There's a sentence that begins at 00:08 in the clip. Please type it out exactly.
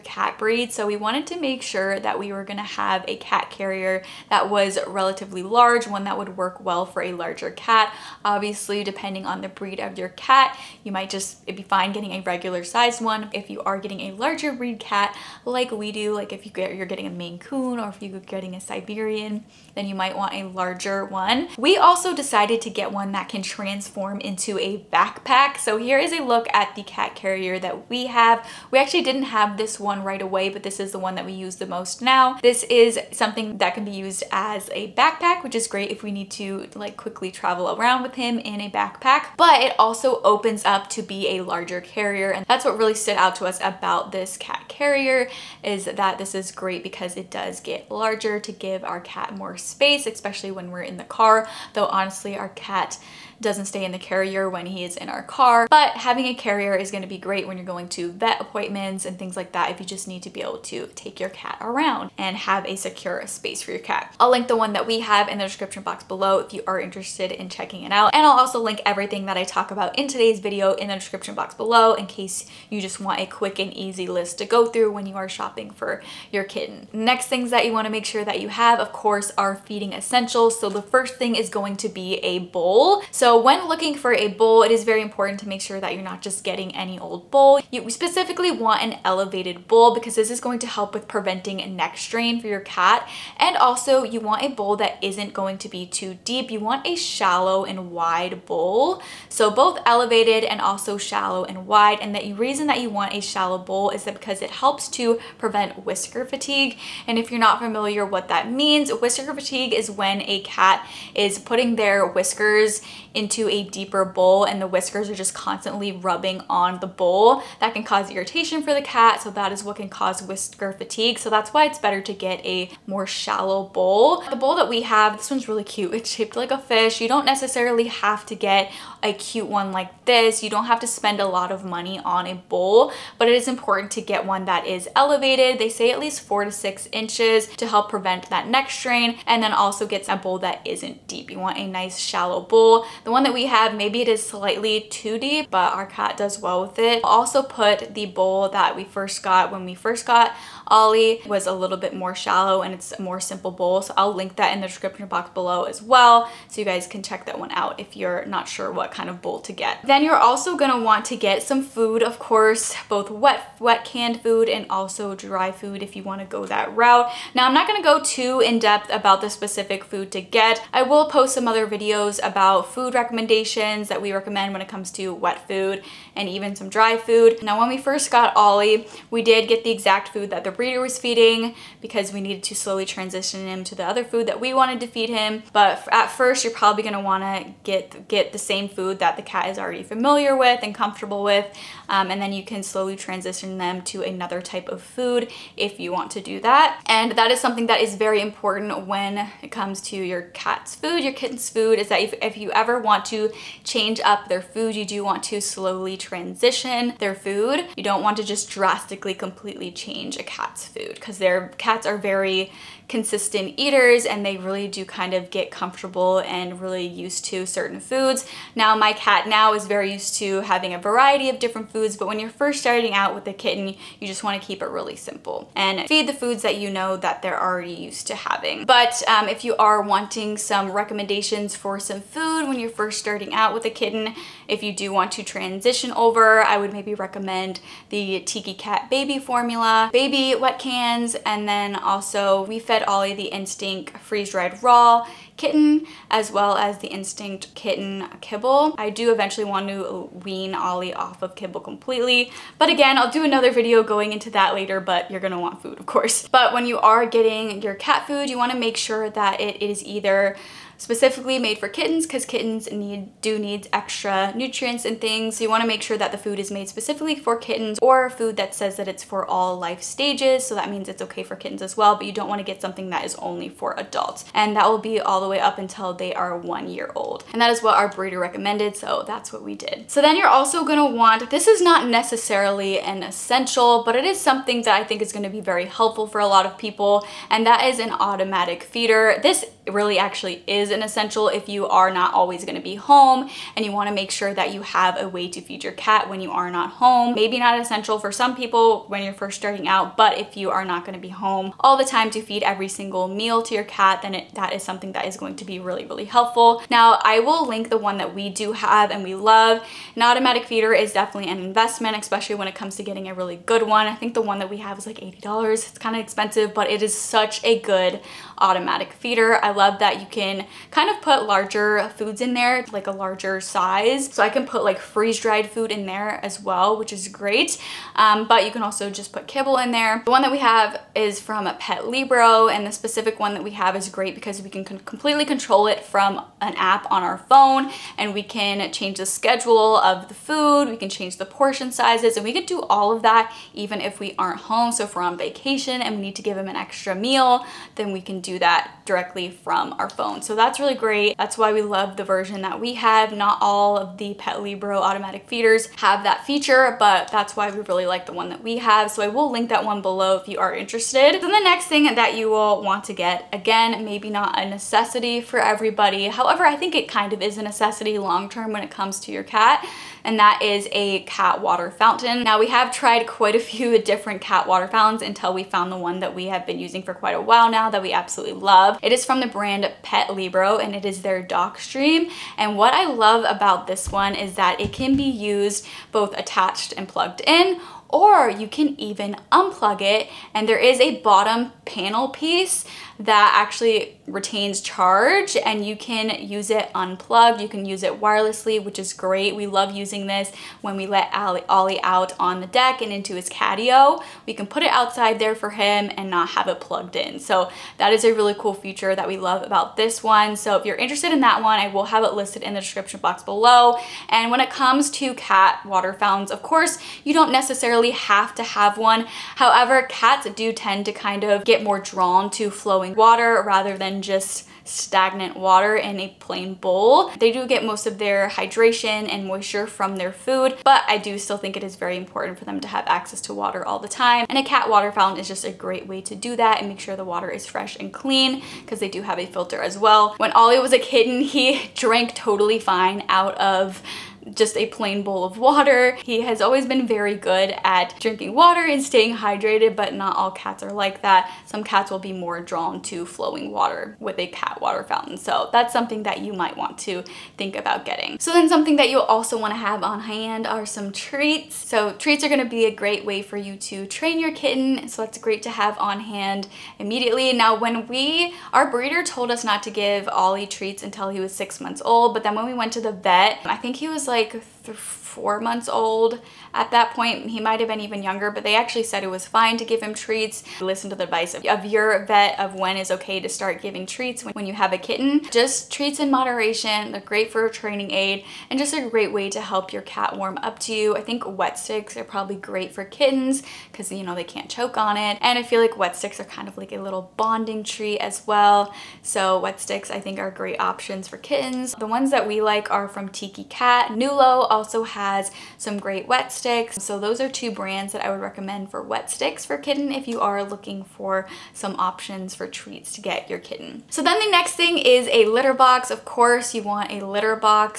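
Obviously, depending on the breed of your cat, you might just, it'd be fine getting a regular sized one.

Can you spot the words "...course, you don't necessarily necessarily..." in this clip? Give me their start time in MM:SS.
06:56.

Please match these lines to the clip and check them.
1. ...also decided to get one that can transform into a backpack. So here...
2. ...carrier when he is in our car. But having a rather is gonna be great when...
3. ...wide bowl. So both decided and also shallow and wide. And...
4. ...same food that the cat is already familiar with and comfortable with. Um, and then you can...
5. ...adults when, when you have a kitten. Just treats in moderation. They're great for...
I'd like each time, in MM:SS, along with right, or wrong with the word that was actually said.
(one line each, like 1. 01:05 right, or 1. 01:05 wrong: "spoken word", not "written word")
1. 00:21 right
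2. 00:53 wrong: "carrier", not "rather"
3. 01:37 wrong: "elevated", not "decided"
4. 03:08 right
5. 08:03 wrong: "treats", not "adults".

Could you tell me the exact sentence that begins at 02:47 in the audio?
Now I'm not gonna go too in depth about the specific food to get.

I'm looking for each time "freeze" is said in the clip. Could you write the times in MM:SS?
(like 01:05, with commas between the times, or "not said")
04:03, 05:24.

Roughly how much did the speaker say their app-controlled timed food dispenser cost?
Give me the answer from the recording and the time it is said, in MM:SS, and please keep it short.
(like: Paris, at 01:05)
$80, at 05:14.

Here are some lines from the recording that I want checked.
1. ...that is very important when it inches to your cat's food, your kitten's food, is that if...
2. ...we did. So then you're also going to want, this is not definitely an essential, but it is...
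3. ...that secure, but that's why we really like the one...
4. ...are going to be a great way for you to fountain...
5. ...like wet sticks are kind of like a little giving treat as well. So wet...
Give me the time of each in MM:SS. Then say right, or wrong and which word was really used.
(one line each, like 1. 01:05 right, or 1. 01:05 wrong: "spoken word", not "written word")
1. 03:17 wrong: "comes", not "inches"
2. 04:39 wrong: "necessarily", not "definitely"
3. 05:56 wrong: "feature", not "secure"
4. 07:42 wrong: "train", not "fountain"
5. 08:15 wrong: "bonding", not "giving".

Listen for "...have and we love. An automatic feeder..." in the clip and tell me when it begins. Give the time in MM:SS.
05:08.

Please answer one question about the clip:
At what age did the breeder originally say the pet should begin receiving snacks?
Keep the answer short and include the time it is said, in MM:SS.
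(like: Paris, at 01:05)
6 months, at 07:51.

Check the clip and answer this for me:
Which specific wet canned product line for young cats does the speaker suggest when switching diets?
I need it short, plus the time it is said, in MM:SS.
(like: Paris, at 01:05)
Tiki Cat Baby, at 03:58.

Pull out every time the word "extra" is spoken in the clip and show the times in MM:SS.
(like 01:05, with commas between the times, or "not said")
04:23, 05:46.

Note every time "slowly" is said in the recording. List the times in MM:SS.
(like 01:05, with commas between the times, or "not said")
03:02, 03:12, 03:25.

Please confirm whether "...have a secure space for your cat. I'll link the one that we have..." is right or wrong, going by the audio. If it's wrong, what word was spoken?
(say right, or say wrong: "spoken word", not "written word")
right.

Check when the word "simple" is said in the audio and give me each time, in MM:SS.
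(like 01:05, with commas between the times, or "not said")
02:33, 03:44.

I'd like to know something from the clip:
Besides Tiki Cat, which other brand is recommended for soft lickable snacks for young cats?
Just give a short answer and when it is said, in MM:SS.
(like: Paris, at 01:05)
Nulo, at 08:23.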